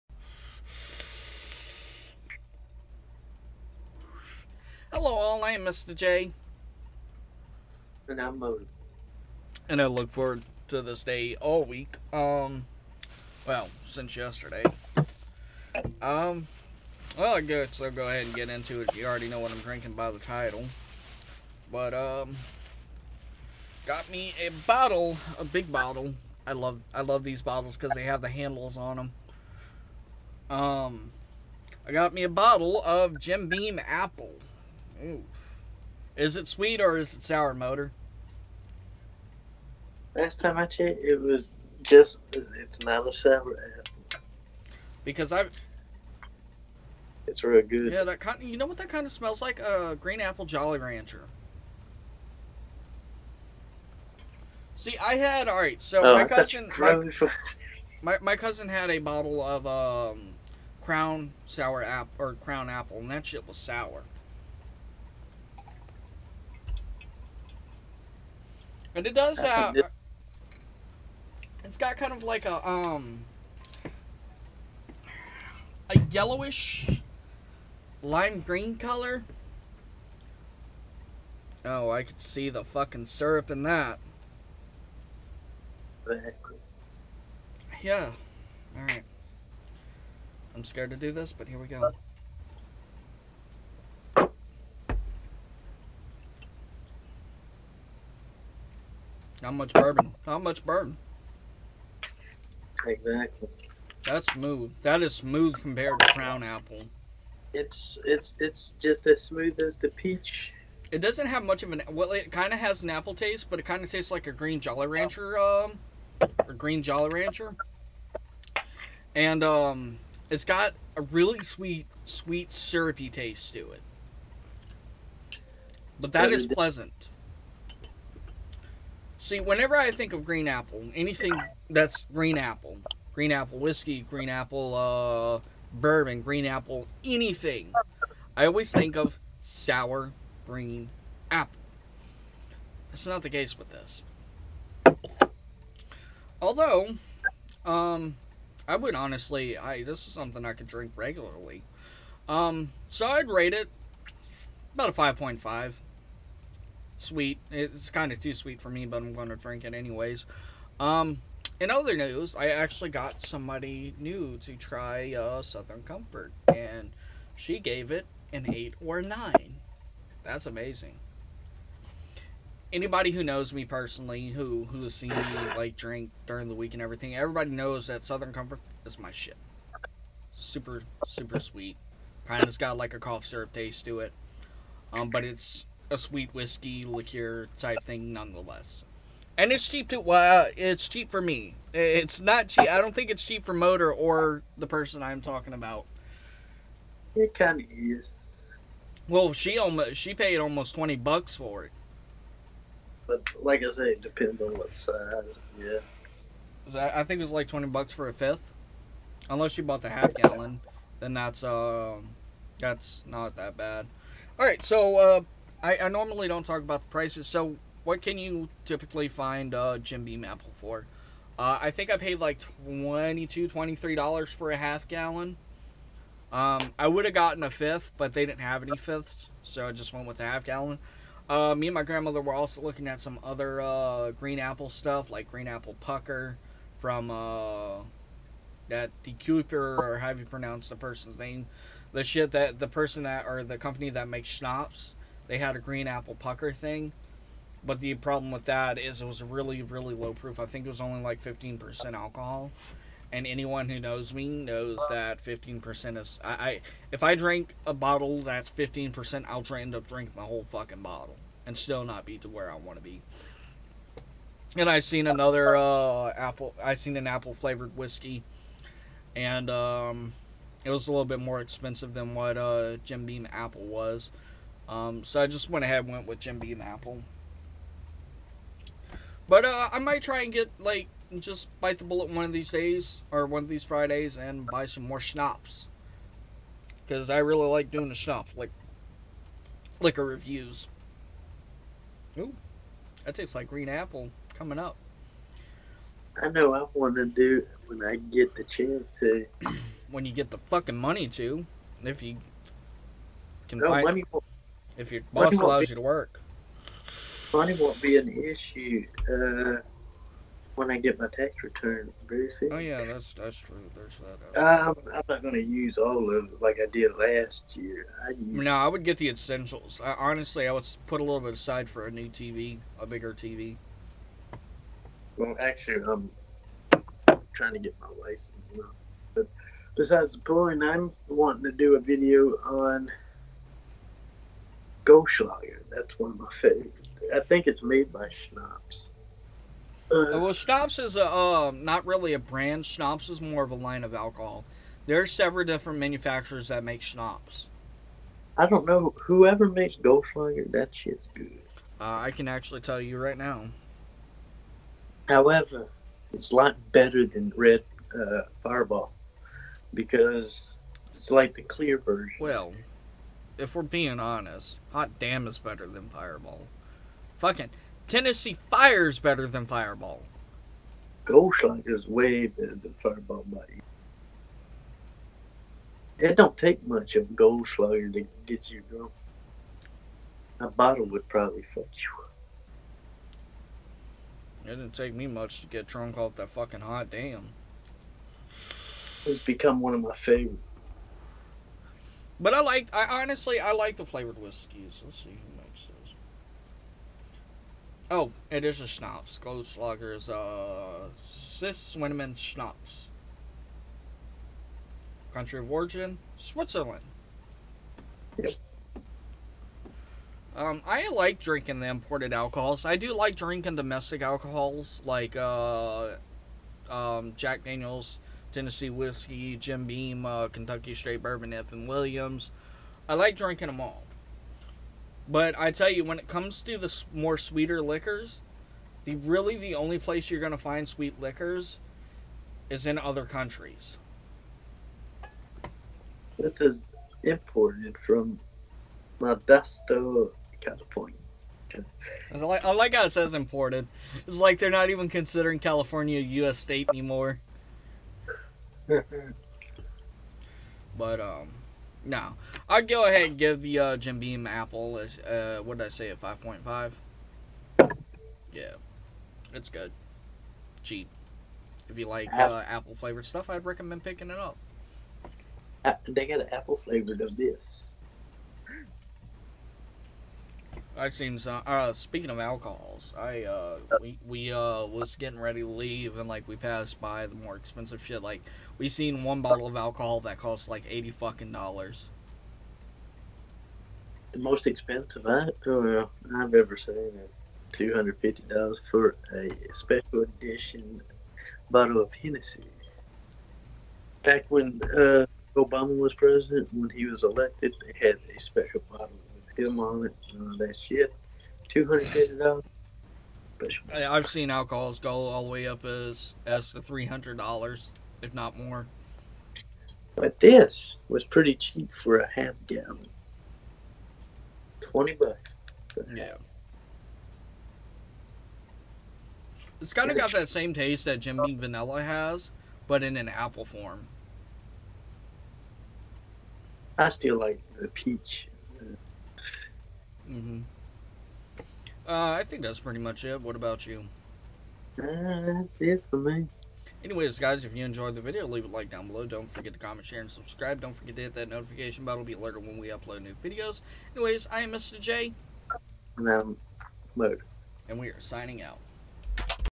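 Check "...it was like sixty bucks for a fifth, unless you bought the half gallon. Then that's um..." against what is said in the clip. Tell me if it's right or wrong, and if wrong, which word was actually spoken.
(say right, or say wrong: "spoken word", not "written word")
wrong: "twenty", not "sixty".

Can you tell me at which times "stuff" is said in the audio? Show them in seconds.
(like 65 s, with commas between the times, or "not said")
234 s, 463 s.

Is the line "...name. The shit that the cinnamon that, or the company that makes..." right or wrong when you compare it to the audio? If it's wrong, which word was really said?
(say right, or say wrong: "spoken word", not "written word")
wrong: "person", not "cinnamon".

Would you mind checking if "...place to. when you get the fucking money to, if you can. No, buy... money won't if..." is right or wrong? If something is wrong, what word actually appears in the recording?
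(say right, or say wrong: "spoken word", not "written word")
wrong: "chance", not "place".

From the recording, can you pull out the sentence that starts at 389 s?
It's become one of my favorites.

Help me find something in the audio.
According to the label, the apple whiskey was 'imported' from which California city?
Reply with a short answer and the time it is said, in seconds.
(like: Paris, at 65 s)
Modesto, at 438 s.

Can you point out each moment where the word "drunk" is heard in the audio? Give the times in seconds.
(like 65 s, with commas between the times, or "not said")
378 s, 385 s.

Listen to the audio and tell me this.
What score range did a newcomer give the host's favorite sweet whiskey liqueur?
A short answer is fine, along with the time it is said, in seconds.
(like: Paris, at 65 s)
8 or 9, at 168 s.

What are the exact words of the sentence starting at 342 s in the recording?
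Schnapps is more of a line of alcohol.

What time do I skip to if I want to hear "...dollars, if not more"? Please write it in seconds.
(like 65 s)
507 s.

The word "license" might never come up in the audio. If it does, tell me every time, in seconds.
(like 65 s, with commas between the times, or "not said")
328 s.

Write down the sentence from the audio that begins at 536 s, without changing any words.
Anyways, guys, if you enjoyed the video, leave a like down below.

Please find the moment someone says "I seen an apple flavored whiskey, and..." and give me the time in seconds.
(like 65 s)
266 s.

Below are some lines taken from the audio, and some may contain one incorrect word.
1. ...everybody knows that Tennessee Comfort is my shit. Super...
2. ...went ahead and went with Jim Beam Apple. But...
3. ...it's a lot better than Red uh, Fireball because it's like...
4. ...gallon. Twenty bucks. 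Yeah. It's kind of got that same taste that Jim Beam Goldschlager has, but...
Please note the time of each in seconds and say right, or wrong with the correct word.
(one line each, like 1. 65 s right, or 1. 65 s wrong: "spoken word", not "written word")
1. 177 s wrong: "Southern", not "Tennessee"
2. 275 s right
3. 356 s right
4. 512 s wrong: "Vanilla", not "Goldschlager".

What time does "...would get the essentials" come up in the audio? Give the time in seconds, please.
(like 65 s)
318 s.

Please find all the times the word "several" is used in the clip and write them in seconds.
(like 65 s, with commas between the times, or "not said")
345 s.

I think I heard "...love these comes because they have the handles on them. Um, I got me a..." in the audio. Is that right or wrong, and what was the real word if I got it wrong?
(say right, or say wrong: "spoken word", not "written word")
wrong: "bottles", not "comes".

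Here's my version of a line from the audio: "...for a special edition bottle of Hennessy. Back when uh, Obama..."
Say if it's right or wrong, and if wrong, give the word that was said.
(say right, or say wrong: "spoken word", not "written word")
right.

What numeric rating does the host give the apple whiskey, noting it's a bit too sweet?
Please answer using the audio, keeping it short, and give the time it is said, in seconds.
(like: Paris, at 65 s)
5.5, at 154 s.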